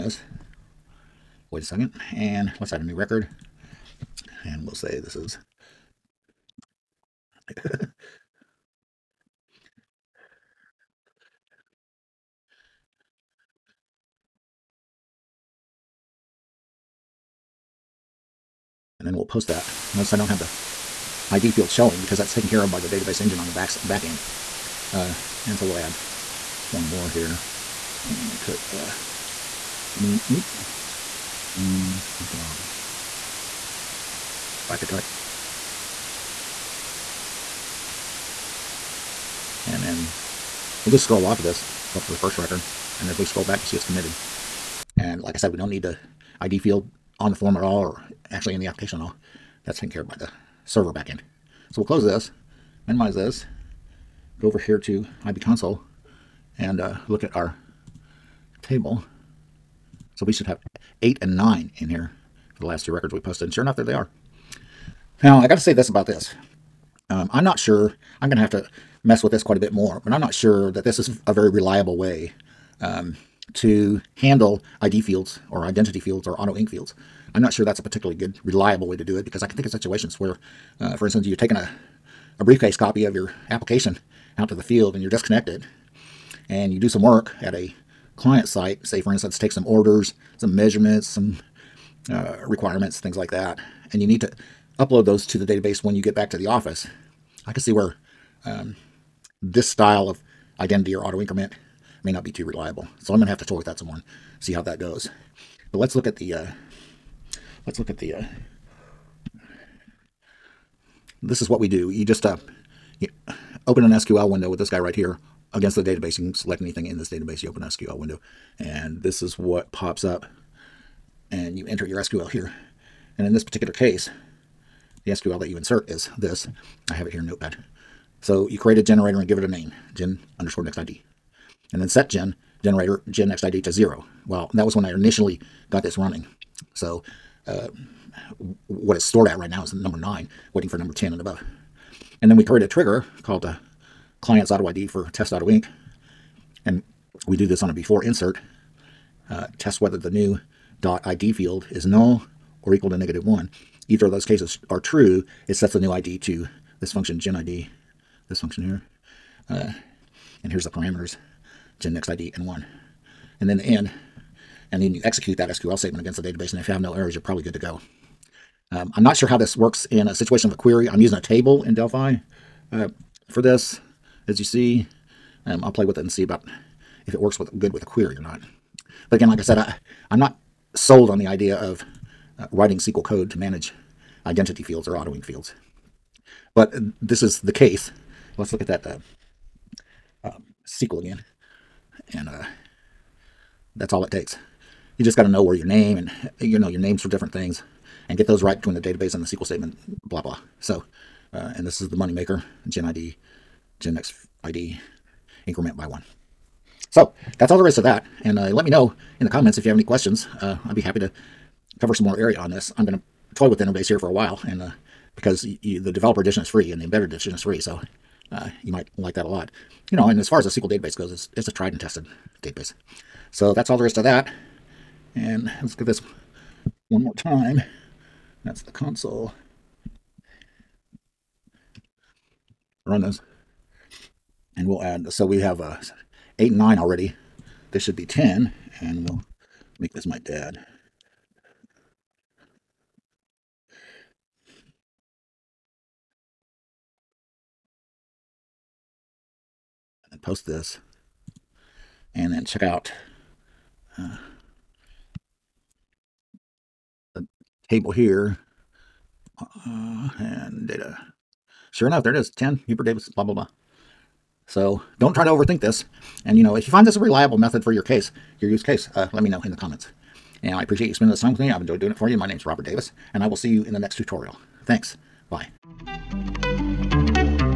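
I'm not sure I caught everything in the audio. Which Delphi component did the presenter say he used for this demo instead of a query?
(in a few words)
A table.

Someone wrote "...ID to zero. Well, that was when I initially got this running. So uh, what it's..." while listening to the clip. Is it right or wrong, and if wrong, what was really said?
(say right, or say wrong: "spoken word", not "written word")
right.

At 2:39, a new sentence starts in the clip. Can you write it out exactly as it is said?
Uh, and here's the parameters to next ID and 1.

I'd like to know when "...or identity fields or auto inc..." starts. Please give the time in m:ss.
1:15.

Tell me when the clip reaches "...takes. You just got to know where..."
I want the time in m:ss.
3:14.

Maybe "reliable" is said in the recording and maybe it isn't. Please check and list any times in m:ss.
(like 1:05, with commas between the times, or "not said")
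1:11, 1:18, 1:42, 4:26.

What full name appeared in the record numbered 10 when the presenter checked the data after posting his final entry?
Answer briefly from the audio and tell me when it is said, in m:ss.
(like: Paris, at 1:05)
Hubert Davis, at 4:22.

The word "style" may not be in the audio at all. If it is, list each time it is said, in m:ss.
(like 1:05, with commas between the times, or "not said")
1:39.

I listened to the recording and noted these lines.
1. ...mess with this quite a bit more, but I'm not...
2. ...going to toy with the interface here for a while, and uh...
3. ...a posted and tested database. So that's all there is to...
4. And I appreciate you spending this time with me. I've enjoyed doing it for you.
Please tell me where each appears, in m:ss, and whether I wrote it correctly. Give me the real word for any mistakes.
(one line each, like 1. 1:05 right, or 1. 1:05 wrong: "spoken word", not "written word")
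1. 1:09 right
2. 3:32 right
3. 3:41 wrong: "tried", not "posted"
4. 4:30 right.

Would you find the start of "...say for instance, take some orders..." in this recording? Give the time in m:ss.
1:28.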